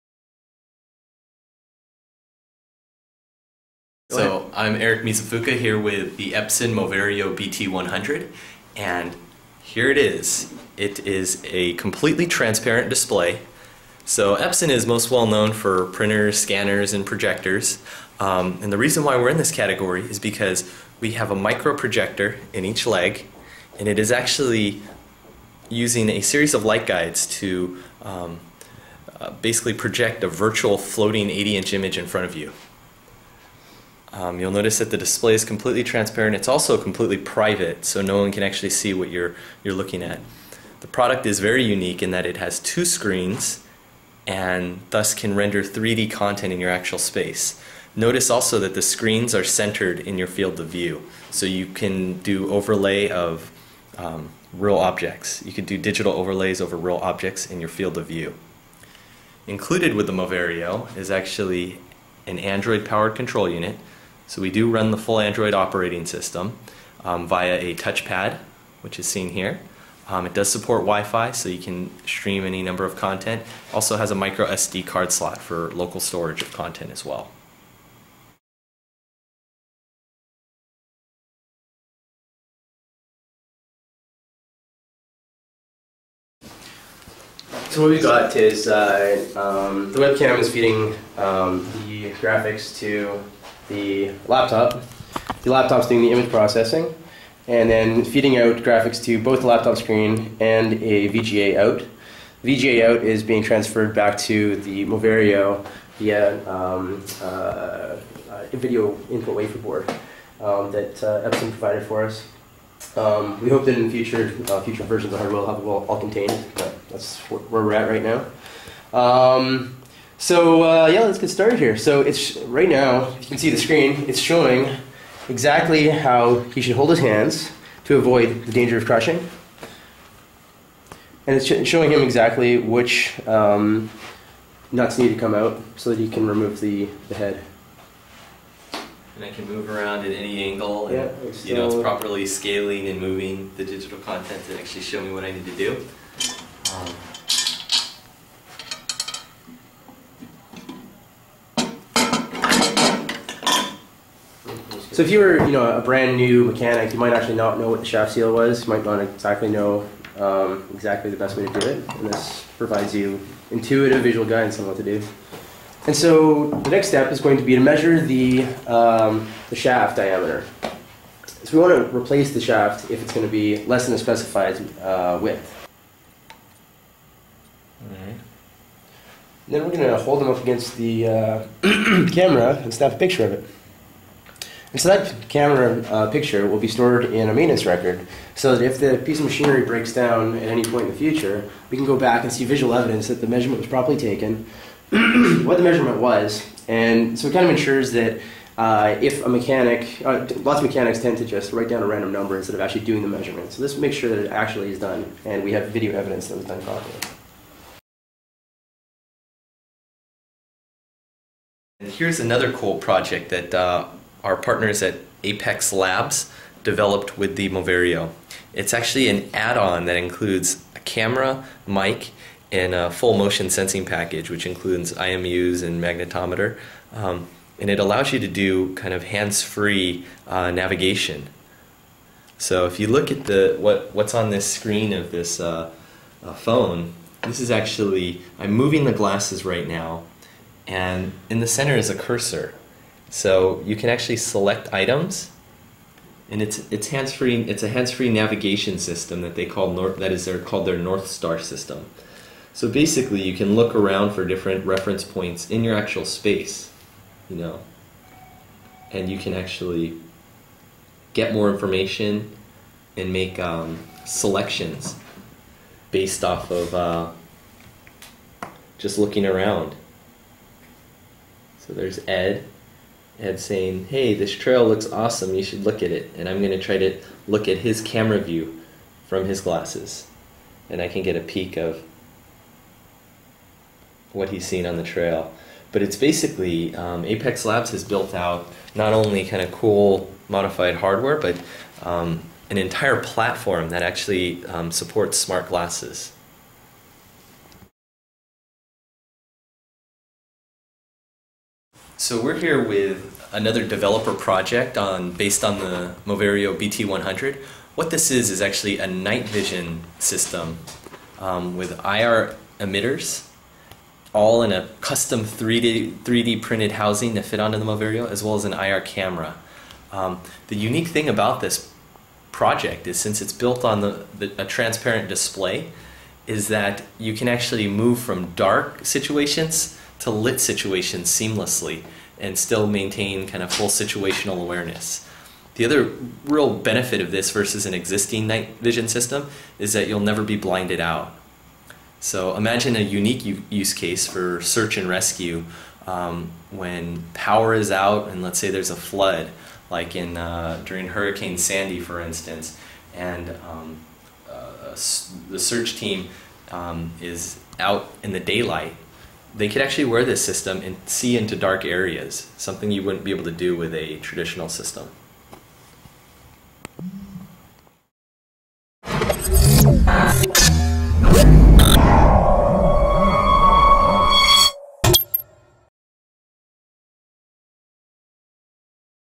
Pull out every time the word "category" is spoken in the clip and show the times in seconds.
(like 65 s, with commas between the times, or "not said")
19 s.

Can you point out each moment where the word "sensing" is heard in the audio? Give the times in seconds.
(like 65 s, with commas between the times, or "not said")
223 s.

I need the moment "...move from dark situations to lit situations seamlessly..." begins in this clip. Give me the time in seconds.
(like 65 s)
327 s.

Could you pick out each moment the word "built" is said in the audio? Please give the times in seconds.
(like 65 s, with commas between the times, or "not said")
287 s, 323 s.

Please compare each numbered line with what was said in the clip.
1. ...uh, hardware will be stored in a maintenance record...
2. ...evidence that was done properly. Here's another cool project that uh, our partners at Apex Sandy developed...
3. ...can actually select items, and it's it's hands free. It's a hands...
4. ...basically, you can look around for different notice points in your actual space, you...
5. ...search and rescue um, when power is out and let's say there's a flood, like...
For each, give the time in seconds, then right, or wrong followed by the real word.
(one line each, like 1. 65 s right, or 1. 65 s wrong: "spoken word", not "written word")
1. 185 s wrong: "picture", not "hardware"
2. 205 s wrong: "Labs", not "Sandy"
3. 243 s right
4. 252 s wrong: "reference", not "notice"
5. 344 s right.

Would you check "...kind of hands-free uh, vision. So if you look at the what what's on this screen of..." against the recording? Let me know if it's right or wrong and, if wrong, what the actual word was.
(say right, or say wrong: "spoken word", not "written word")
wrong: "navigation", not "vision".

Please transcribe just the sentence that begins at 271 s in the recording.
So there's Ed had saying, "Hey, this trail looks awesome.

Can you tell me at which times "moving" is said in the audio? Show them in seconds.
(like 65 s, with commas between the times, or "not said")
143 s, 238 s.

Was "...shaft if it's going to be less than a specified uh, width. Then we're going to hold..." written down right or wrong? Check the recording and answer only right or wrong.
right.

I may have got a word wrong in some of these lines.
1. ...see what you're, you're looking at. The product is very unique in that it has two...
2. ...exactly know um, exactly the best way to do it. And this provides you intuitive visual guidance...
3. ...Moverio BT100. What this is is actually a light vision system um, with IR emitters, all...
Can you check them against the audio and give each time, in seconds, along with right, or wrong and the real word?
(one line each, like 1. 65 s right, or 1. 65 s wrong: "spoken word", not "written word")
1. 38 s right
2. 158 s right
3. 306 s wrong: "night", not "light".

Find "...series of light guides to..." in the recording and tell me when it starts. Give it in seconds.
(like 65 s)
26 s.